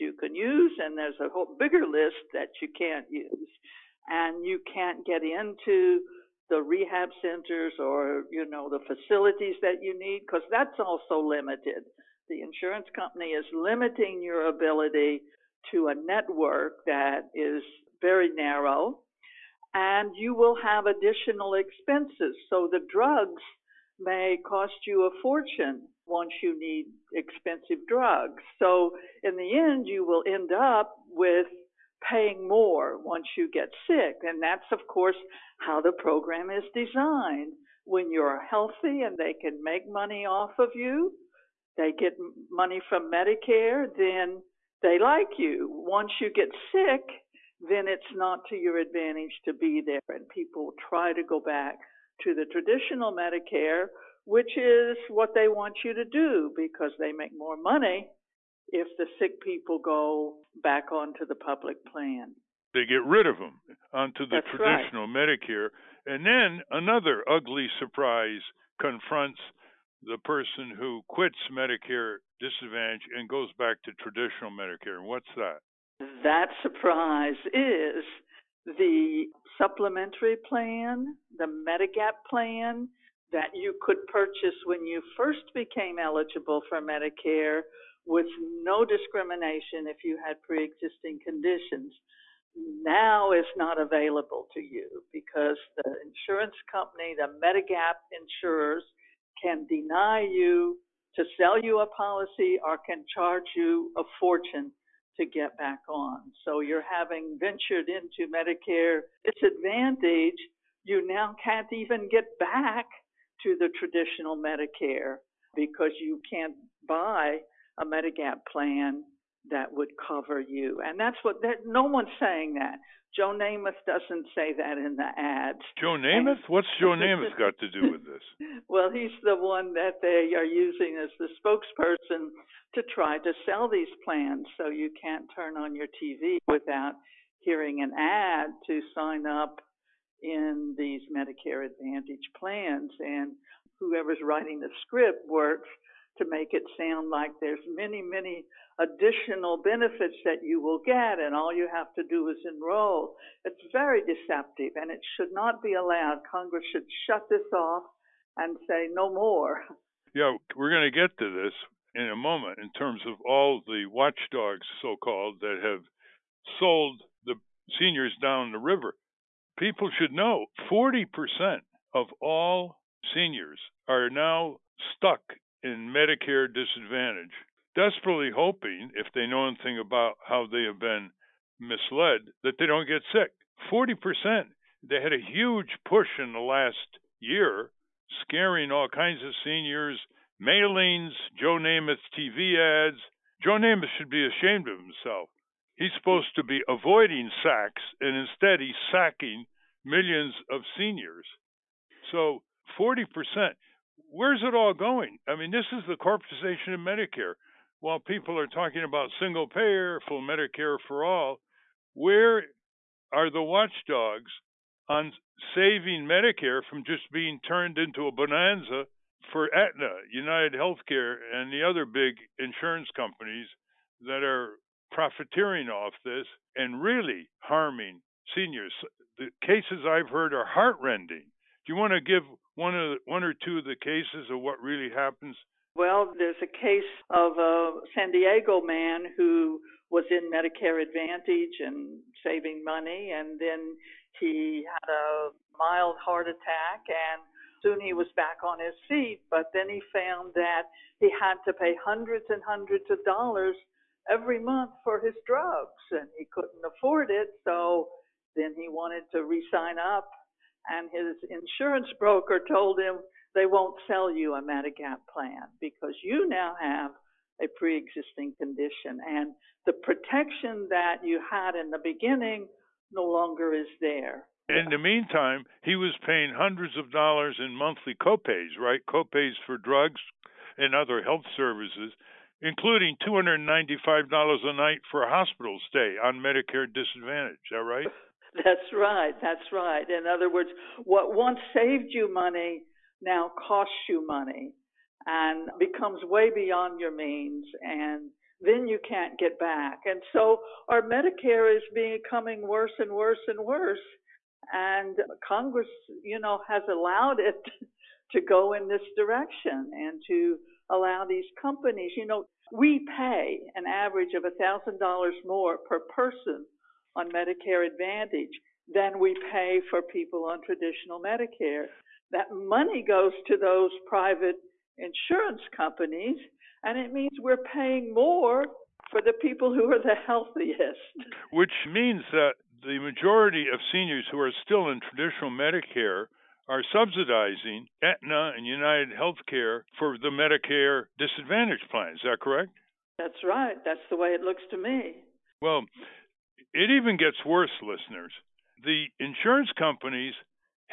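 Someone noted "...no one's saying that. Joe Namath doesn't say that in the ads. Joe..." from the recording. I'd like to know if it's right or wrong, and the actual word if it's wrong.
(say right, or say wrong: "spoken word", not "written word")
right.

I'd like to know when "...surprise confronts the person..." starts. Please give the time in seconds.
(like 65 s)
67 s.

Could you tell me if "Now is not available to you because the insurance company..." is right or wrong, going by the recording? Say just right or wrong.
right.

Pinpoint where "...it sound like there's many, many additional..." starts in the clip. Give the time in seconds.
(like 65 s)
146 s.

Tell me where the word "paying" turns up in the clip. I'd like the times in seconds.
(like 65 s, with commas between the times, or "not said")
32 s, 276 s, 327 s.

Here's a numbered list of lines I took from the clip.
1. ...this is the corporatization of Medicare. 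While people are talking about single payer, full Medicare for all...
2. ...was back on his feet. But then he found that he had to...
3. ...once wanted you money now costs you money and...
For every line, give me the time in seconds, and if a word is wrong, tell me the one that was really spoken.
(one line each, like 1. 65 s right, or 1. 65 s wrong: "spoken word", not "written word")
1. 205 s right
2. 247 s right
3. 291 s wrong: "saved", not "wanted".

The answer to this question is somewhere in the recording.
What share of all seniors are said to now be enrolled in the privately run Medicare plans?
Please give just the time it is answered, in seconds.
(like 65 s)
170 s.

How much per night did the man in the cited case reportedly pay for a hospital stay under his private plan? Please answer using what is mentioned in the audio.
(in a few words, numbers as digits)
$295.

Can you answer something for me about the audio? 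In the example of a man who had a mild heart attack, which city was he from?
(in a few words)
San Diego.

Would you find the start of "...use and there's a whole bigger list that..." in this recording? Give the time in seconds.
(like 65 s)
0 s.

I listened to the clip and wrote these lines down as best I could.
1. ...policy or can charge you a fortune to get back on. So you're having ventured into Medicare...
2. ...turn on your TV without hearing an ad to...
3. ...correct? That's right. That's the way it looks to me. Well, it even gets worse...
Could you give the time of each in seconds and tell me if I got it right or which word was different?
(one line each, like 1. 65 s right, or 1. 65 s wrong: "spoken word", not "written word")
1. 101 s right
2. 135 s right
3. 342 s right.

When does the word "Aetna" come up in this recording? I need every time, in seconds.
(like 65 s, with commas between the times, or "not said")
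219 s, 337 s.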